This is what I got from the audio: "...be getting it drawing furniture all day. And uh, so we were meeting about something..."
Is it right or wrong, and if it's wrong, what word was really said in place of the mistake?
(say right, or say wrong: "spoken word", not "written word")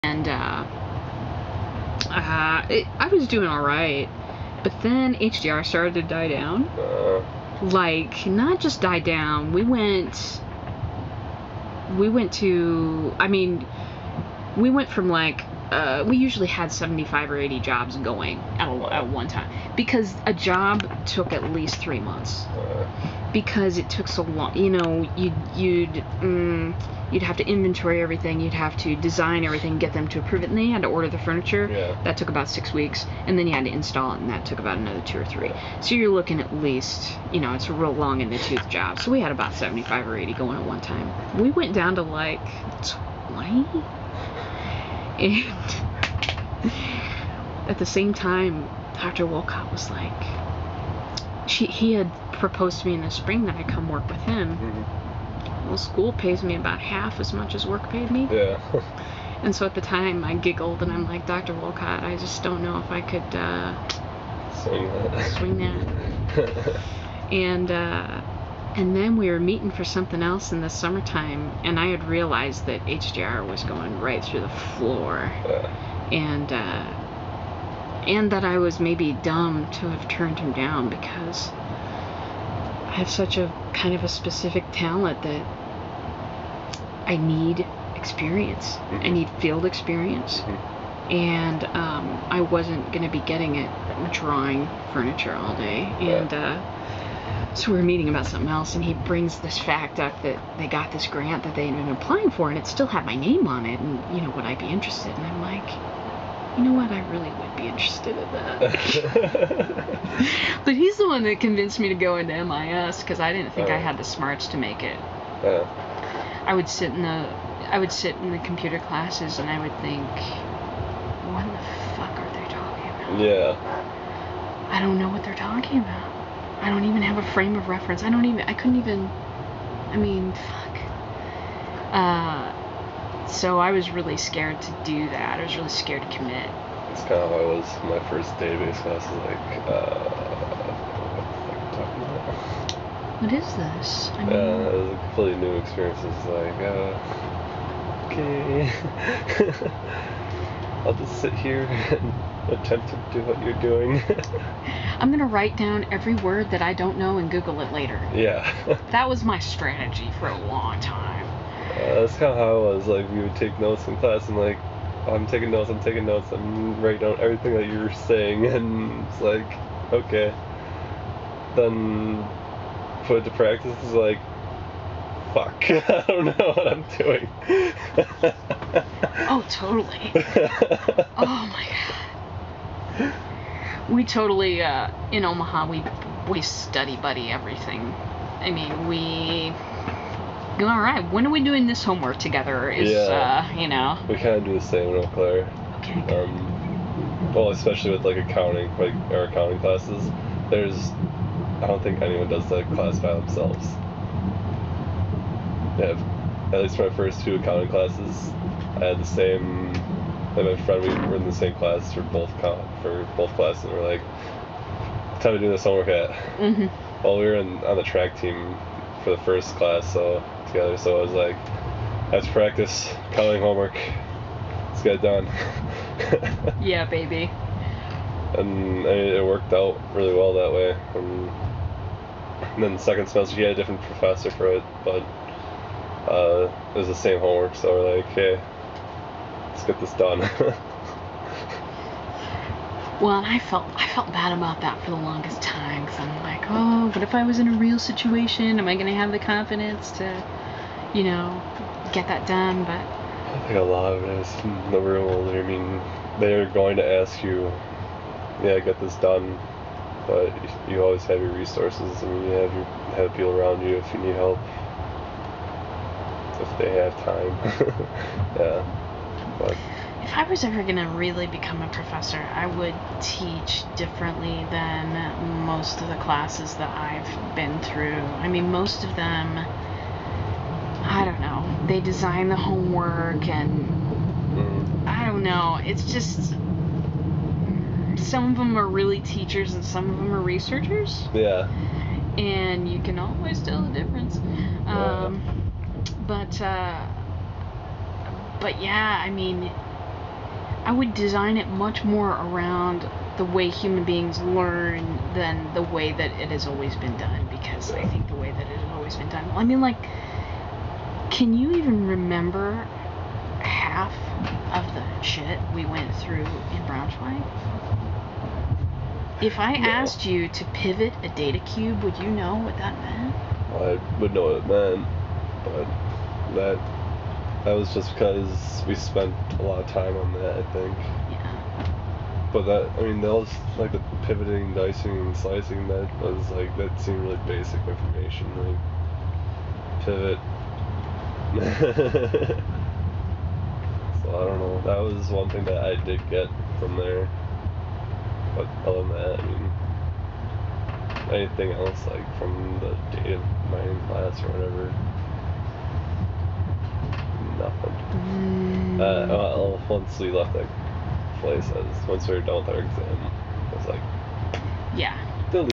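right.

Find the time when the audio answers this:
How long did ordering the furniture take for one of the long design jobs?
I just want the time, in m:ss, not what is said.
0:32.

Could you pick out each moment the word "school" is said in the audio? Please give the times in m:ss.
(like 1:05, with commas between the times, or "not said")
0:55.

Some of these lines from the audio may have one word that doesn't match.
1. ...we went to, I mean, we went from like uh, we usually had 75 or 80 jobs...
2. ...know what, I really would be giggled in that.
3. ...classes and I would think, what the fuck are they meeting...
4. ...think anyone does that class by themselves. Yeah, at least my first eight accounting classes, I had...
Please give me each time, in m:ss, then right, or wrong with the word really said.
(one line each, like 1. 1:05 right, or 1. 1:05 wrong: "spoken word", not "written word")
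1. 0:11 right
2. 1:46 wrong: "interested", not "giggled"
3. 1:58 wrong: "talking", not "meeting"
4. 3:21 wrong: "two", not "eight".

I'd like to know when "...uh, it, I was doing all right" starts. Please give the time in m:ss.
0:02.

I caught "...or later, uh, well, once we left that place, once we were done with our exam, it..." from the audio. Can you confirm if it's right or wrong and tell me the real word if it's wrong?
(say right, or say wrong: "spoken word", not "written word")
wrong: "whatever", not "later".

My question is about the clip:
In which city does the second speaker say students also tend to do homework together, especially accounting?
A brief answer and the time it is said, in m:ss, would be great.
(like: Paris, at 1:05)
Eau Claire, at 3:15.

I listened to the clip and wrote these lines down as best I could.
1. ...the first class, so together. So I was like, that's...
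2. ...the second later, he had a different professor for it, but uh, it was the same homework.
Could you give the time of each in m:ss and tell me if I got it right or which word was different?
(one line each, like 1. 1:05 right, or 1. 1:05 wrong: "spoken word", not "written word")
1. 3:39 right
2. 3:52 wrong: "semester", not "later".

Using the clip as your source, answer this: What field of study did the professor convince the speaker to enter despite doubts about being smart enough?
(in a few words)
MIS.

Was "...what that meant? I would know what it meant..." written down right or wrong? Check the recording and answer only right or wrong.
right.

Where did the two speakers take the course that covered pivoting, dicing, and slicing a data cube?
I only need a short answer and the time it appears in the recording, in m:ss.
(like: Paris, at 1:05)
Braunschweig, at 5:16.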